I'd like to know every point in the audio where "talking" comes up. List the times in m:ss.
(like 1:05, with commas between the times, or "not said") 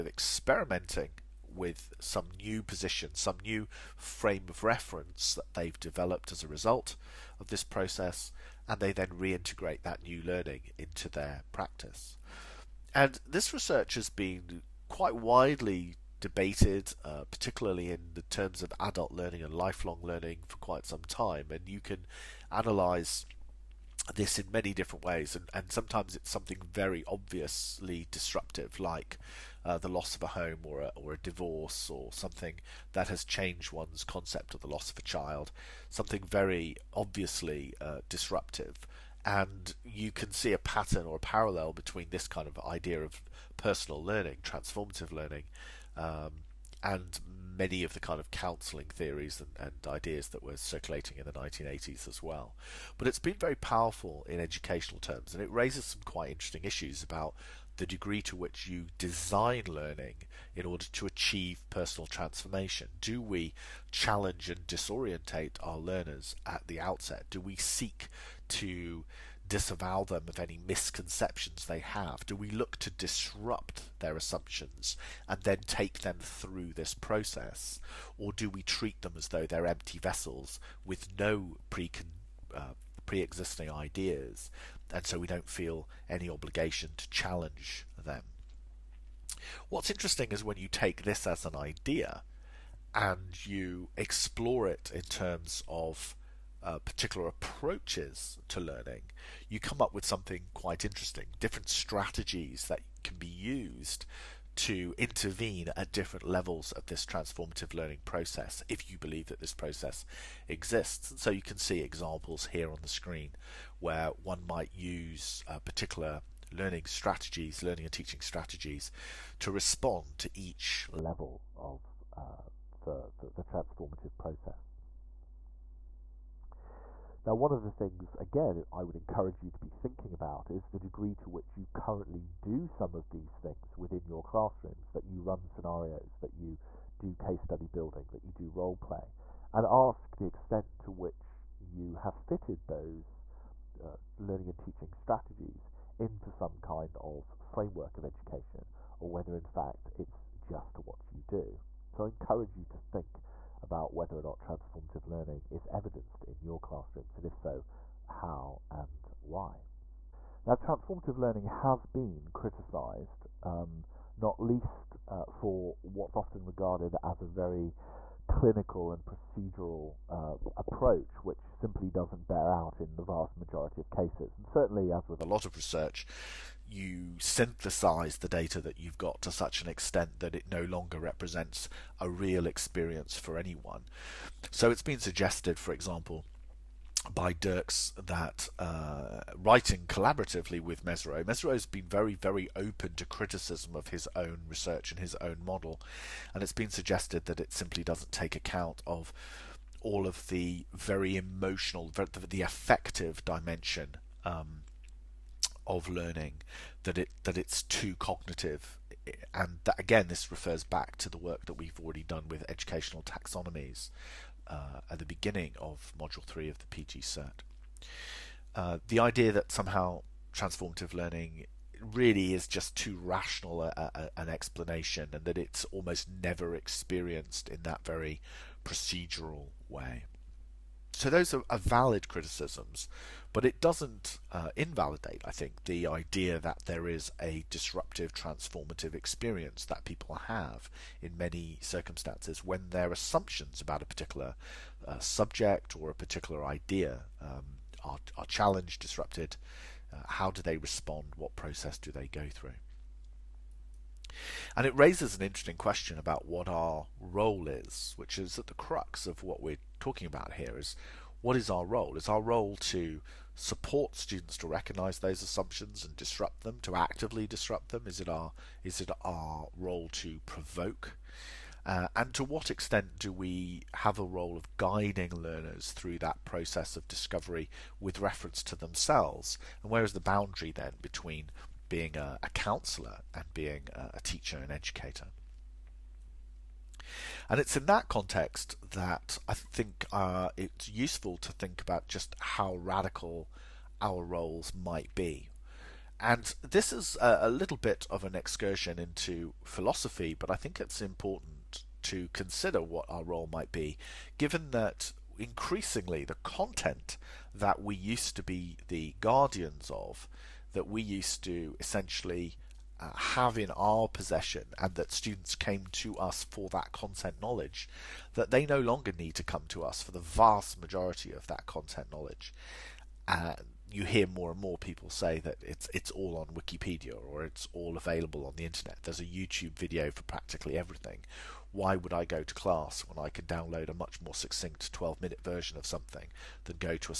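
4:19.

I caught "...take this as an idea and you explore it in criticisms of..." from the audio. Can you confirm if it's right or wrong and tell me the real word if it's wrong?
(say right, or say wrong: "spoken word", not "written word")
wrong: "terms", not "criticisms".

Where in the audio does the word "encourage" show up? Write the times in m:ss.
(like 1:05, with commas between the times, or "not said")
2:08, 2:32.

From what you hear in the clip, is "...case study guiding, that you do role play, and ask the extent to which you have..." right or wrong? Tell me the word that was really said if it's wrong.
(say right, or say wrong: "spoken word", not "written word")
wrong: "building", not "guiding".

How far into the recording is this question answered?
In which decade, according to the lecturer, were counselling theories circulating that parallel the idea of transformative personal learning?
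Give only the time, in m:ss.
0:51.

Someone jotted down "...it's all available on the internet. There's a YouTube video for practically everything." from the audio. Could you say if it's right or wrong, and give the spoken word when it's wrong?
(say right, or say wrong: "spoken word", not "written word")
right.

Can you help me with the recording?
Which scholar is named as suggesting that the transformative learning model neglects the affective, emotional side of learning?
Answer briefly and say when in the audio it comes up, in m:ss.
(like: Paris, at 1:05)
Dirkx, at 3:07.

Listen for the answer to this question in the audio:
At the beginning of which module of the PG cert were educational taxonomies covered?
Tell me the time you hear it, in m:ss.
3:35.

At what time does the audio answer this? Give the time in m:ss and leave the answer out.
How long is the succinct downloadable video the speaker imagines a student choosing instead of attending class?
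5:34.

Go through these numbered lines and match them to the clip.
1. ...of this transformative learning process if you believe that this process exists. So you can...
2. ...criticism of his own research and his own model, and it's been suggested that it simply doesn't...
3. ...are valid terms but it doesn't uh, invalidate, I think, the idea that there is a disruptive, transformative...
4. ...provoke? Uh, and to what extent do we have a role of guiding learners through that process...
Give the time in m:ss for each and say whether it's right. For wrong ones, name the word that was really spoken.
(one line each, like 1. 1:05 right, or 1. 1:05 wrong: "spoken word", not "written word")
1. 1:46 right
2. 3:13 right
3. 3:51 wrong: "criticisms", not "terms"
4. 4:30 right.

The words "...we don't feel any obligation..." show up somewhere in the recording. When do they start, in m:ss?
1:25.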